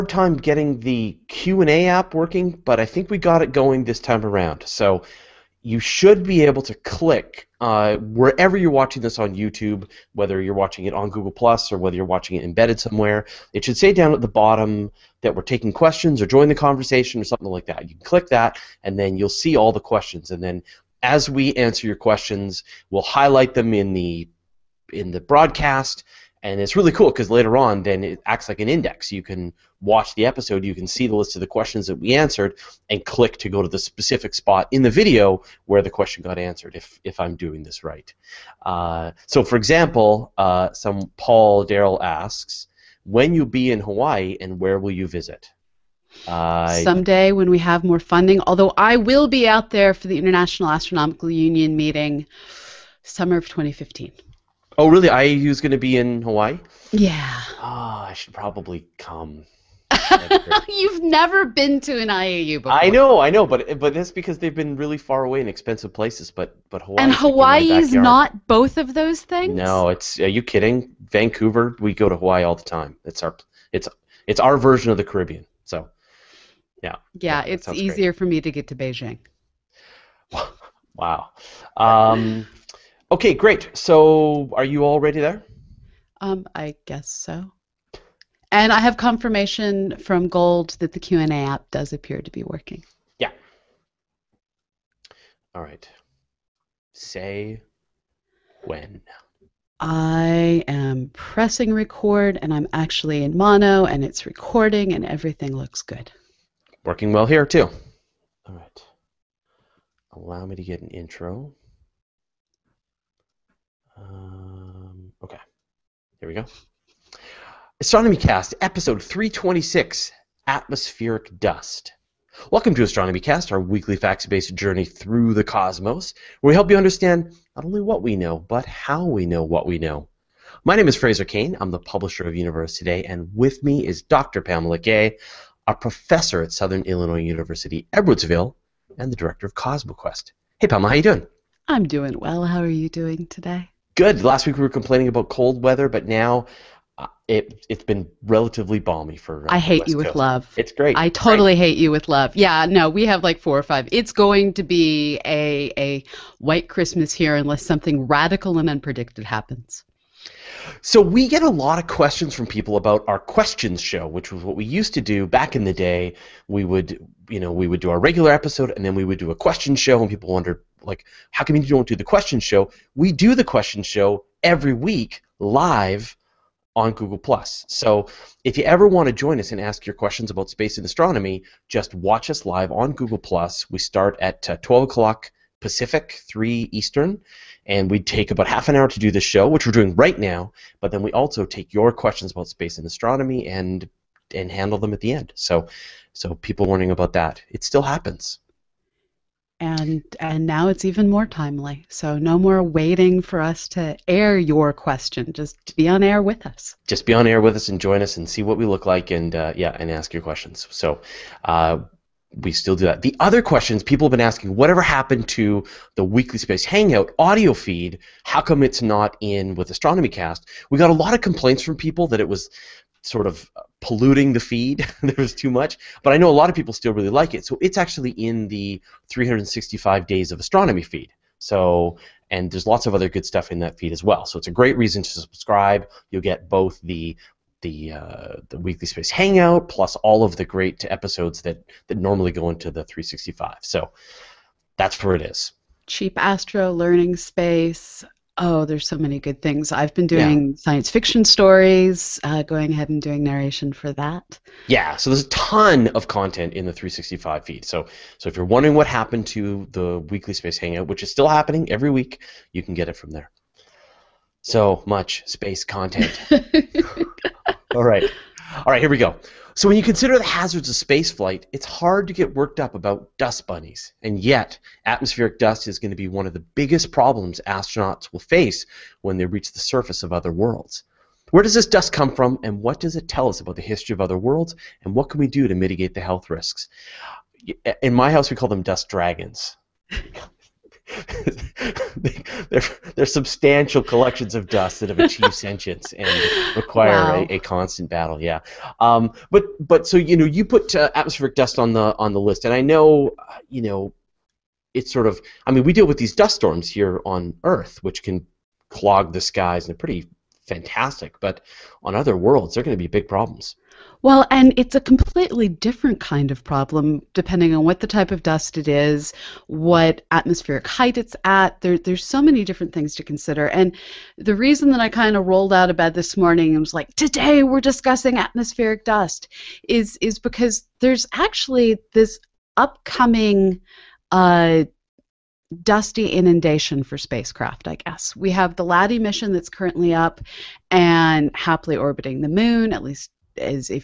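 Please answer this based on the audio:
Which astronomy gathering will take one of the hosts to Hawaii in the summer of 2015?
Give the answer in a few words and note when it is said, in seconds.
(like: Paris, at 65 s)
International Astronomical Union meeting, at 50 s.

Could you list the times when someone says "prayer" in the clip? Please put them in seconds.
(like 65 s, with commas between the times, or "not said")
not said.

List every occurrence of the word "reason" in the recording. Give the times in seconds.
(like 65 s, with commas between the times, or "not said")
234 s, 324 s.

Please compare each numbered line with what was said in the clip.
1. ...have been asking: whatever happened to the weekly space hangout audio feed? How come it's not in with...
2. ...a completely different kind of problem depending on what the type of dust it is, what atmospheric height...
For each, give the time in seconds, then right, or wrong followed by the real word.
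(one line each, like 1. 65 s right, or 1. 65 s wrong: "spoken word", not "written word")
1. 214 s right
2. 314 s right.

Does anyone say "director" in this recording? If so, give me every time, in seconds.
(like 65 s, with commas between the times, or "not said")
139 s.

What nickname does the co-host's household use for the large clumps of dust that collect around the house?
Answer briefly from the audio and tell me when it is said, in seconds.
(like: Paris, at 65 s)
dust dragons, at 288 s.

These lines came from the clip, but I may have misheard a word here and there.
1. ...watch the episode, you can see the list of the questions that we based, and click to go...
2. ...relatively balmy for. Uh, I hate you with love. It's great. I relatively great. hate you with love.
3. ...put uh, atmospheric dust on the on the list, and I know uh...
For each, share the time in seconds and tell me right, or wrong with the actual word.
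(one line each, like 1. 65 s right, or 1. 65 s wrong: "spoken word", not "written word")
1. 29 s wrong: "answered", not "based"
2. 148 s wrong: "totally", not "relatively"
3. 300 s right.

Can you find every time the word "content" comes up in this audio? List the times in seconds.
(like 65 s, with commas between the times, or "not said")
256 s, 265 s.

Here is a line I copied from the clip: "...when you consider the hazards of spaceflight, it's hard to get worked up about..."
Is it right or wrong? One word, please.
right.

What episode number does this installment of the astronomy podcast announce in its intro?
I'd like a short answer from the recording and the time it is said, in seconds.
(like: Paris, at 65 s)
326, at 119 s.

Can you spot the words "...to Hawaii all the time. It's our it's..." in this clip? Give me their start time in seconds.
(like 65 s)
72 s.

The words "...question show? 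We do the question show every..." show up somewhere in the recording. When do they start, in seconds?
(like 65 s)
172 s.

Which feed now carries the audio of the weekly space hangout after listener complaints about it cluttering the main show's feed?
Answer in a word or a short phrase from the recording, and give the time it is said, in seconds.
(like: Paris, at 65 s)
365 Days of Astronomy, at 229 s.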